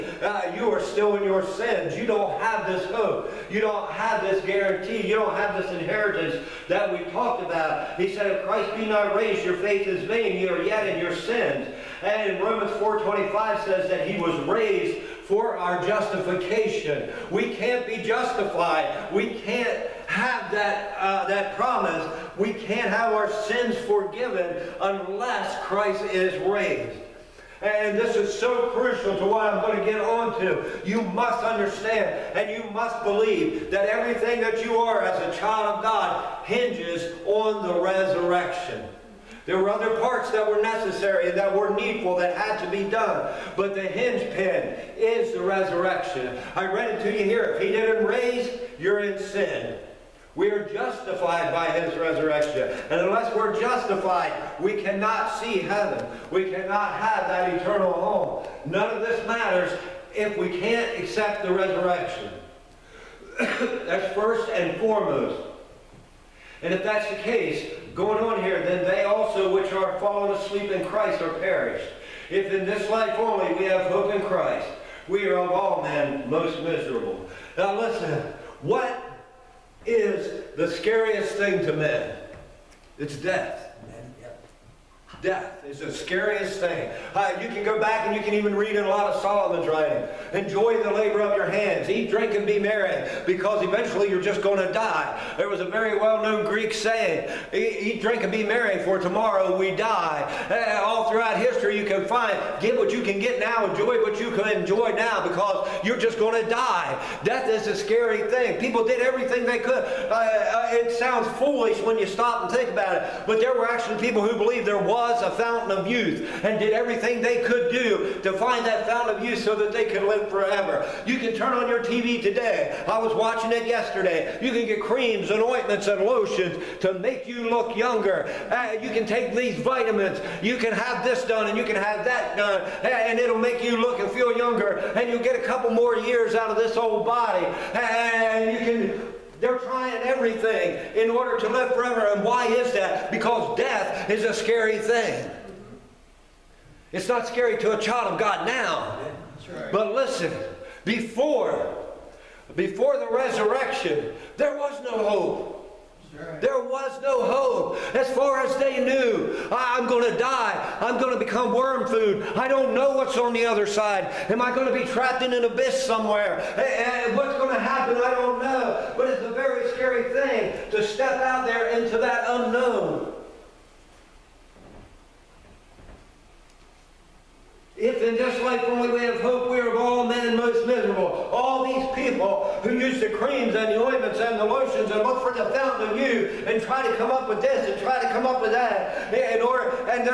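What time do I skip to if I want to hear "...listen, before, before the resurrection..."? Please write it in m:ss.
2:29.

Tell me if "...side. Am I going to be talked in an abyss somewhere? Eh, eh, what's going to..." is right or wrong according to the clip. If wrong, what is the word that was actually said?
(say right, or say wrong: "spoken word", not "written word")
wrong: "trapped", not "talked".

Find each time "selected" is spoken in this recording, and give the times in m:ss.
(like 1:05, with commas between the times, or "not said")
not said.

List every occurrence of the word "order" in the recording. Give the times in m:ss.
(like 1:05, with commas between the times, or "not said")
2:21, 3:09.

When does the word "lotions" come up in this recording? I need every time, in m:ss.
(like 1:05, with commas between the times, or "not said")
2:06, 3:04.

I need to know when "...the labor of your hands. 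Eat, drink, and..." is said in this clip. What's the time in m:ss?
1:30.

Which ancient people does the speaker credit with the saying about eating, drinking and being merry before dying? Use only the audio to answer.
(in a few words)
Greek.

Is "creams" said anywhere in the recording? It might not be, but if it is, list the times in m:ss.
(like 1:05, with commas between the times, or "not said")
2:04, 3:03.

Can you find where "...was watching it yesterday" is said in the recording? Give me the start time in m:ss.
2:02.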